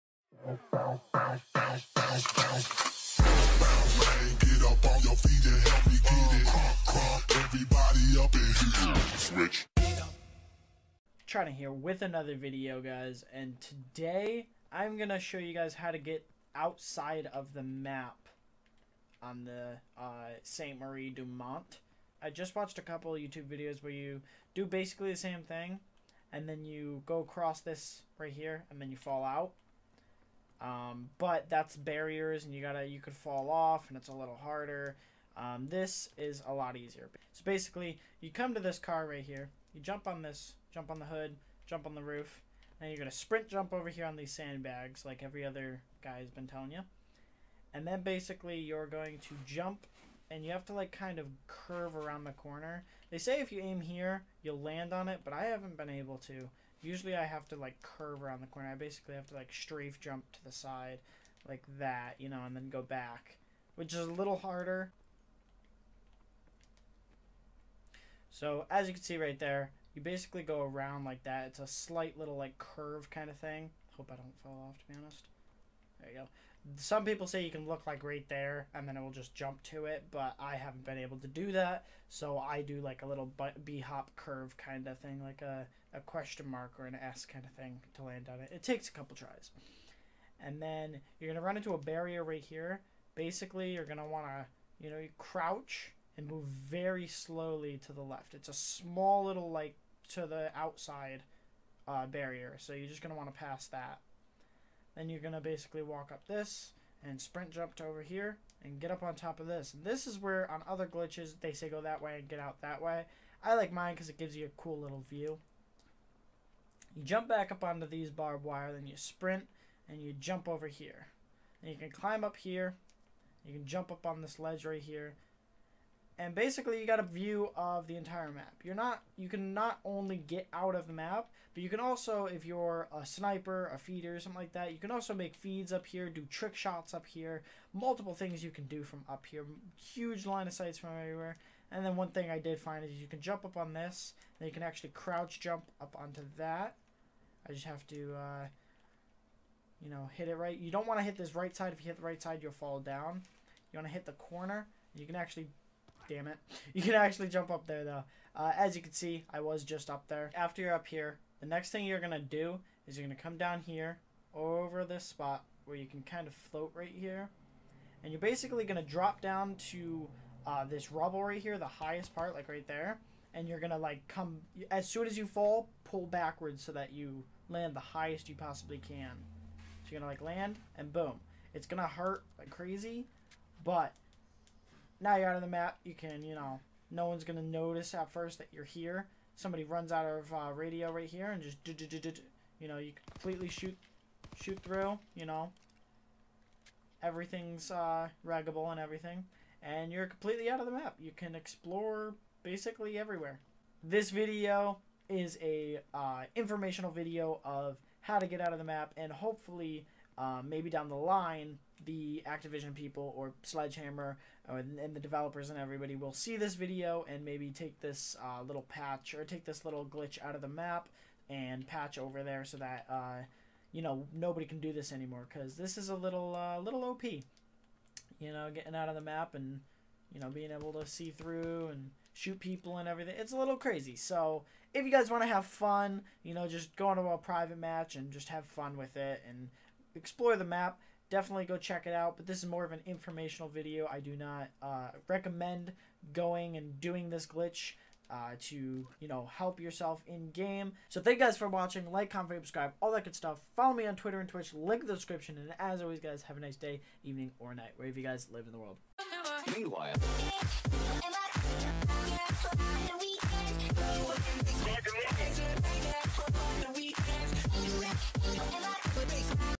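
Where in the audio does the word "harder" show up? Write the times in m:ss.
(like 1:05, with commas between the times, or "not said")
0:34, 1:04.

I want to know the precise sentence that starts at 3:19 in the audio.
And you're completely out of the map.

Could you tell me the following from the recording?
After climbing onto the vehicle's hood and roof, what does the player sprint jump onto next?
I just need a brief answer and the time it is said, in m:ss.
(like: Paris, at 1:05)
sandbags, at 0:44.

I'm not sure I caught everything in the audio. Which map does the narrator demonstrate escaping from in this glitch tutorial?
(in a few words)
Sainte Marie du Mont.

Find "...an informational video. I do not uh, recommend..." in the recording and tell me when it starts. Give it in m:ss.
4:02.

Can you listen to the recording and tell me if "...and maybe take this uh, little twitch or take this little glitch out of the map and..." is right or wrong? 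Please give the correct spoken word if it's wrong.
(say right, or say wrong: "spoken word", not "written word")
wrong: "patch", not "twitch".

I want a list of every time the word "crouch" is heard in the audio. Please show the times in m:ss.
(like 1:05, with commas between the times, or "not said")
1:35, 2:24.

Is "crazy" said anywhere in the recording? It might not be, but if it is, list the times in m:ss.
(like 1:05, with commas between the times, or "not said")
3:02, 3:53.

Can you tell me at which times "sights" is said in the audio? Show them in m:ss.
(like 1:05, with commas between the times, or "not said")
2:20.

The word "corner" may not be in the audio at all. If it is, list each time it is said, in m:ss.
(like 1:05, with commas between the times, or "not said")
0:52, 0:58, 2:34.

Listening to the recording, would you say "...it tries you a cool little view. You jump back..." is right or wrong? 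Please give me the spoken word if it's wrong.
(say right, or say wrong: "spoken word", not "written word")
wrong: "gives", not "tries".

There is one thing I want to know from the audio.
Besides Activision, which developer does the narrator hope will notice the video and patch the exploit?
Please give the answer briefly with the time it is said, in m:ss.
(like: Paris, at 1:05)
Sledgehammer, at 3:33.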